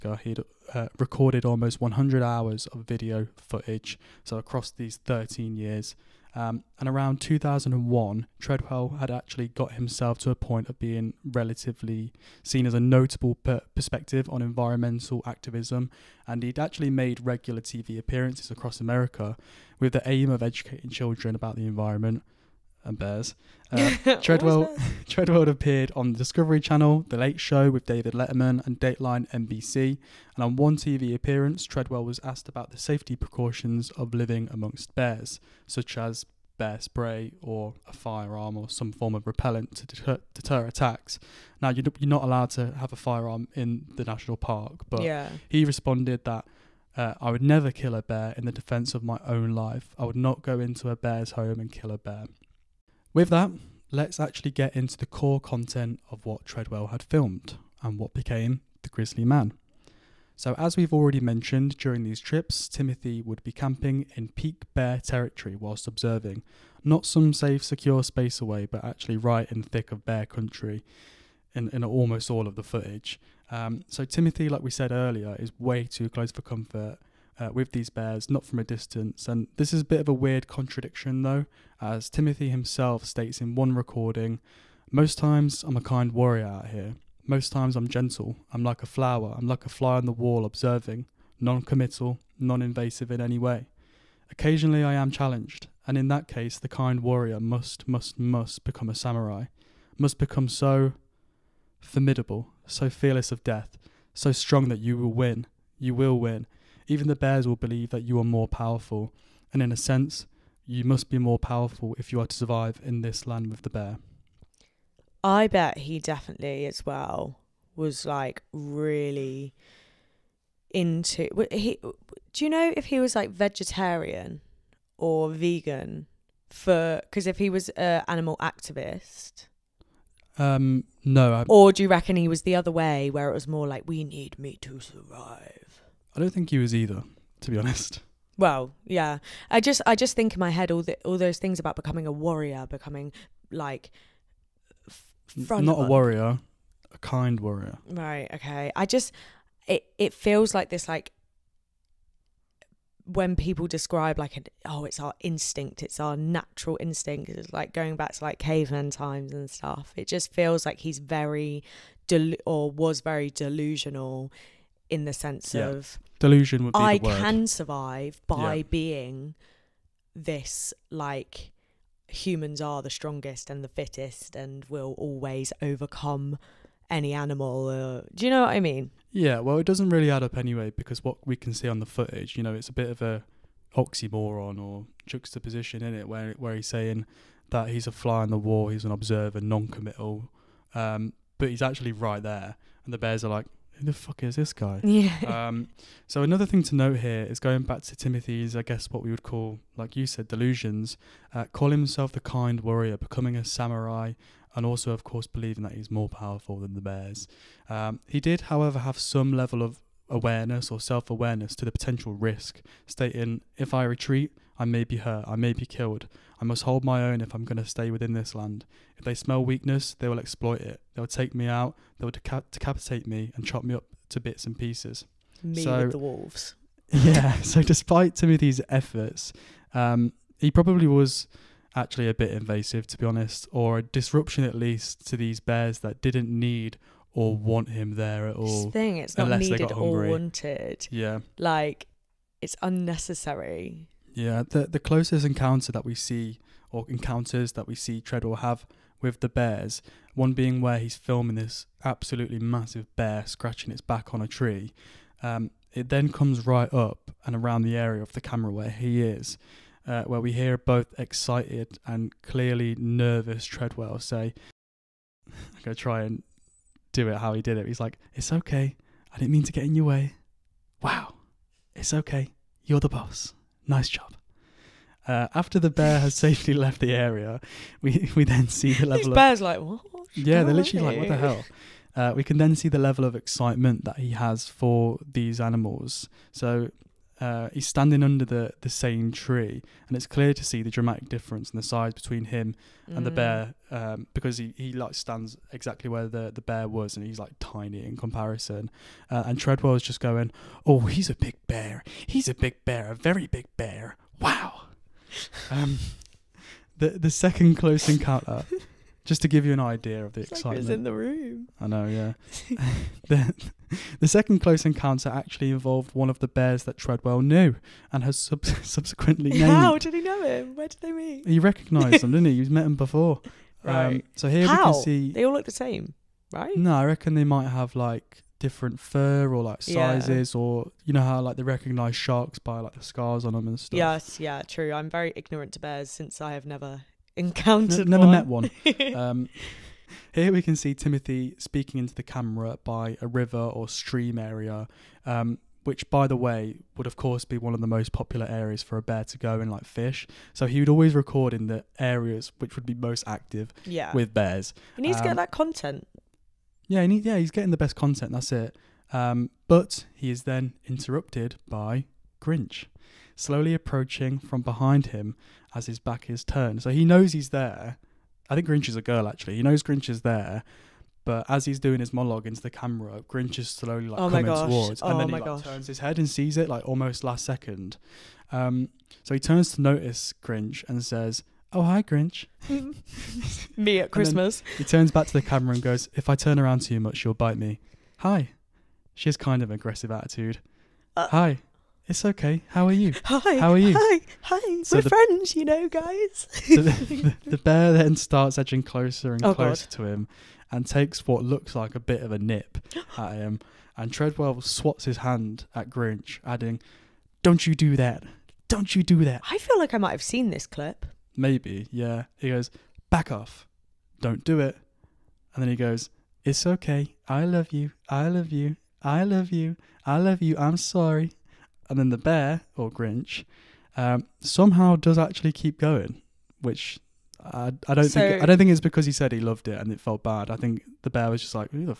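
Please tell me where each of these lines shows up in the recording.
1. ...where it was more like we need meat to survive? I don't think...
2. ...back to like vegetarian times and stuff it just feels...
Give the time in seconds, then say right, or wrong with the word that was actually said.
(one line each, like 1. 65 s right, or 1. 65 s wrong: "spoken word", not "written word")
1. 133 s right
2. 157 s wrong: "caveman", not "vegetarian".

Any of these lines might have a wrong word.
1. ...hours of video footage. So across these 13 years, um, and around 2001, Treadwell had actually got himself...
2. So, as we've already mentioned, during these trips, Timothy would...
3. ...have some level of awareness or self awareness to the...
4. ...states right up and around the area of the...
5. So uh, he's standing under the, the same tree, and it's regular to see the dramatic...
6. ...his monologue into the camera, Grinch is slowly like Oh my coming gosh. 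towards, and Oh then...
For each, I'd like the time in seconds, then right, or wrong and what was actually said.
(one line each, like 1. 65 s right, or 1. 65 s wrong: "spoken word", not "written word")
1. 2 s right
2. 60 s right
3. 208 s right
4. 256 s wrong: "comes", not "states"
5. 286 s wrong: "clear", not "regular"
6. 371 s right.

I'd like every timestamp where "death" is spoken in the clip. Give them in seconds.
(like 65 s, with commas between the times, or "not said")
103 s.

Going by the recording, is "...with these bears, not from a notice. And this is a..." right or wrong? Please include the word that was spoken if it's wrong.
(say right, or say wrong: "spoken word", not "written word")
wrong: "distance", not "notice".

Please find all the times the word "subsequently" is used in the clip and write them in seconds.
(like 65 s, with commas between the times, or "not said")
318 s.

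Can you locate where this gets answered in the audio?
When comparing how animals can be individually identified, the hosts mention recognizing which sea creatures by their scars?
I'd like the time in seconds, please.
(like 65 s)
331 s.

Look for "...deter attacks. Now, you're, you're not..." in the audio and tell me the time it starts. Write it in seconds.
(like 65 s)
40 s.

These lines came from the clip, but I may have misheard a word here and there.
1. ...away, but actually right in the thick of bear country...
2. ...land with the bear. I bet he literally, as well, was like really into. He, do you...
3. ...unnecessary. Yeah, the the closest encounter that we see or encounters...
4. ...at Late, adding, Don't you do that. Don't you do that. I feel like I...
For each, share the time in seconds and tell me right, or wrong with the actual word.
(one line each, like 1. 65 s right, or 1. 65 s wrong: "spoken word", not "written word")
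1. 68 s right
2. 113 s wrong: "definitely", not "literally"
3. 242 s right
4. 405 s wrong: "Grinch", not "Late".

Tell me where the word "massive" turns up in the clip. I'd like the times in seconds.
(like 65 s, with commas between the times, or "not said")
252 s.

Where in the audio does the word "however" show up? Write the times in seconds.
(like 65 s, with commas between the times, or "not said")
208 s.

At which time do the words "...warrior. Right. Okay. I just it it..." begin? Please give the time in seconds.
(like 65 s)
147 s.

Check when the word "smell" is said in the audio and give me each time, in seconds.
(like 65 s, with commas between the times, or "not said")
219 s.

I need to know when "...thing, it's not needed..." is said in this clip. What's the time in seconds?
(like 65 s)
238 s.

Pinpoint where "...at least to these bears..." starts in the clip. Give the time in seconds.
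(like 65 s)
234 s.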